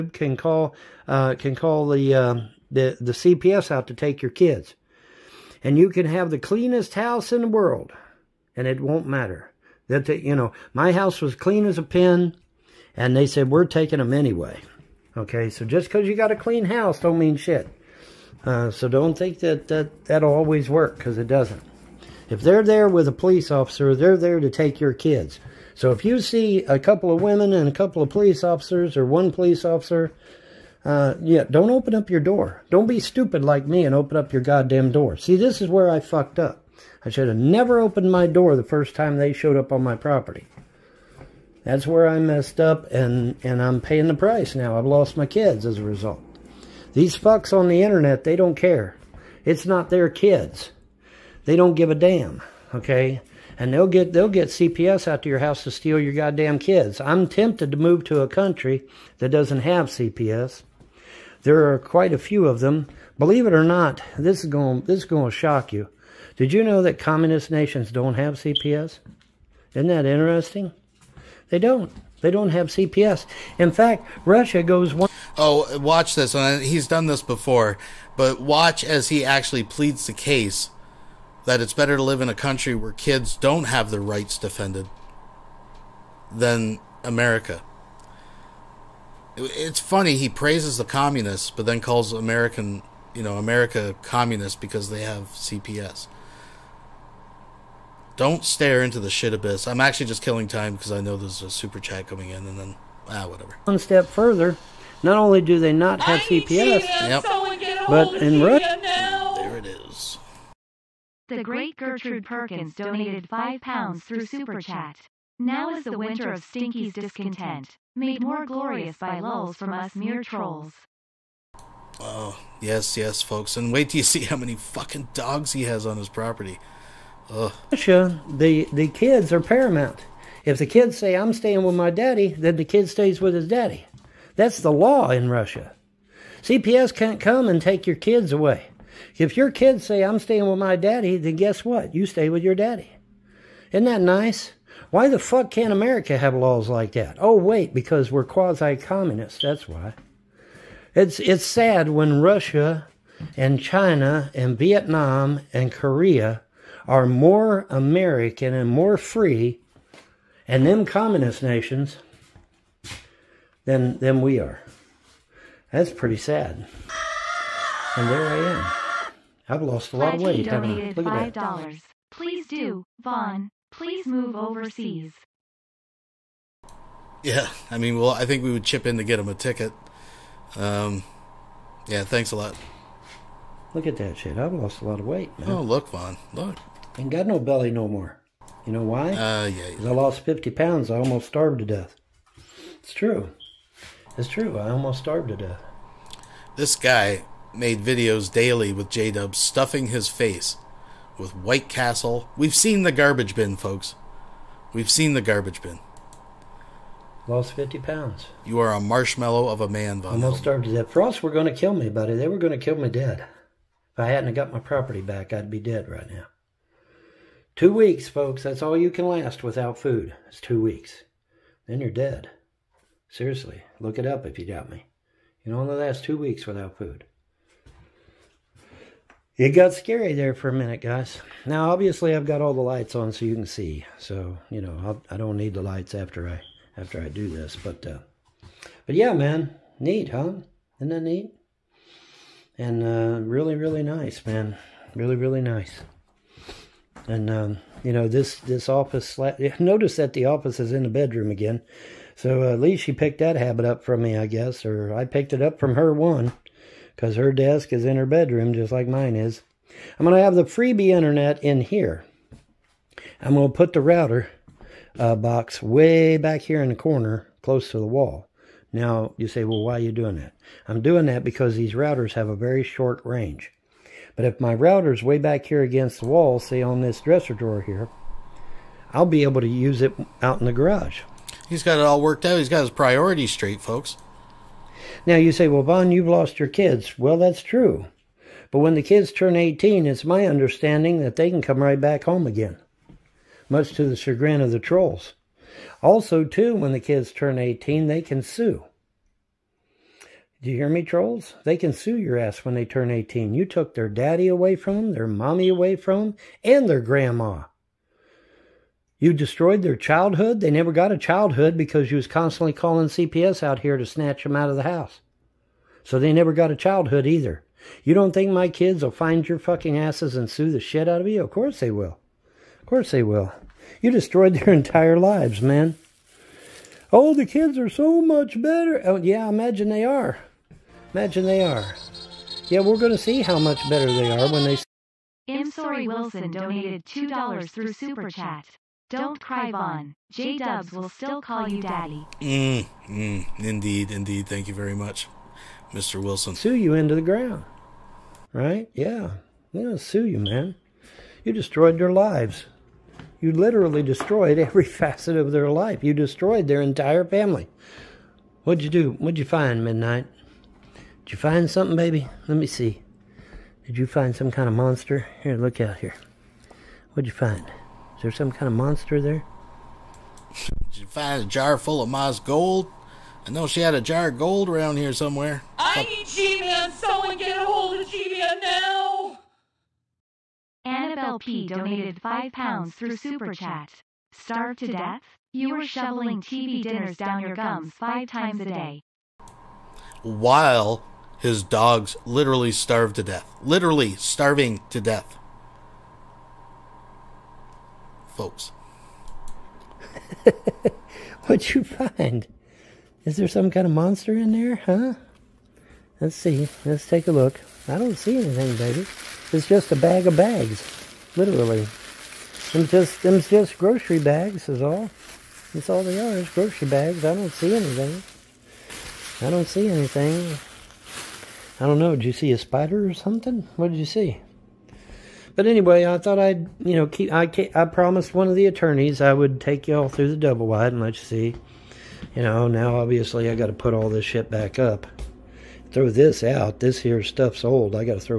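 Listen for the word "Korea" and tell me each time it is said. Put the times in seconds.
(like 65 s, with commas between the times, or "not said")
155 s.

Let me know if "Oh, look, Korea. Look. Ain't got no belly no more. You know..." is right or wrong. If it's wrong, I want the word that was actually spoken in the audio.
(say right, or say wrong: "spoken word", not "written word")
wrong: "Von", not "Korea".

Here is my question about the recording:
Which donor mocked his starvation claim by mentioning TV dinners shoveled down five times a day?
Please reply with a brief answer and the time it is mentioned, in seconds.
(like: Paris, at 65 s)
Annabelle P., at 380 s.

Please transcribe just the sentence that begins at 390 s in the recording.
While his dogs literally starved to death.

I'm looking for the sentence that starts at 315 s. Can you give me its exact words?
So they never got a childhood either.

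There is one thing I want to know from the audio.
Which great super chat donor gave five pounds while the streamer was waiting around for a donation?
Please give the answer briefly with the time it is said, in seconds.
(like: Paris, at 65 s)
Gertrude Perkins, at 111 s.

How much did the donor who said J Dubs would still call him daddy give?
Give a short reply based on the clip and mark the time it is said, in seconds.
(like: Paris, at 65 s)
$2, at 336 s.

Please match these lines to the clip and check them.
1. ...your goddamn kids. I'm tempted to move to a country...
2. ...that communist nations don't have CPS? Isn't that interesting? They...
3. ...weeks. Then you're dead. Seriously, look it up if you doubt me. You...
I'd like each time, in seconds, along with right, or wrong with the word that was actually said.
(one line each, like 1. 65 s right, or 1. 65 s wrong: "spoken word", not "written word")
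1. 56 s right
2. 66 s right
3. 220 s right.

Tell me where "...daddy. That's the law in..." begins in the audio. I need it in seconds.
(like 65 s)
133 s.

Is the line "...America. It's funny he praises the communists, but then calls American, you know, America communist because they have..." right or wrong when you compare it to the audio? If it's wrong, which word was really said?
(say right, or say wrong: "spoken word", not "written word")
right.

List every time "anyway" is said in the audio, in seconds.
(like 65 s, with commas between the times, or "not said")
14 s, 425 s.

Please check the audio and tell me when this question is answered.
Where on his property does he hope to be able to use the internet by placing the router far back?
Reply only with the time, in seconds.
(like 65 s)
280 s.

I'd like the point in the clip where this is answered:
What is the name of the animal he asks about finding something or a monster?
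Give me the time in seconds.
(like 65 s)
359 s.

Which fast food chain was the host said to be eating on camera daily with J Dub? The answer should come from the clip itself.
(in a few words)
White Castle.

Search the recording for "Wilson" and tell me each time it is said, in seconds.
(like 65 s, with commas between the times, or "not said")
335 s, 346 s.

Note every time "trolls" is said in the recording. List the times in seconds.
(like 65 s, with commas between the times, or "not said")
120 s, 294 s, 300 s.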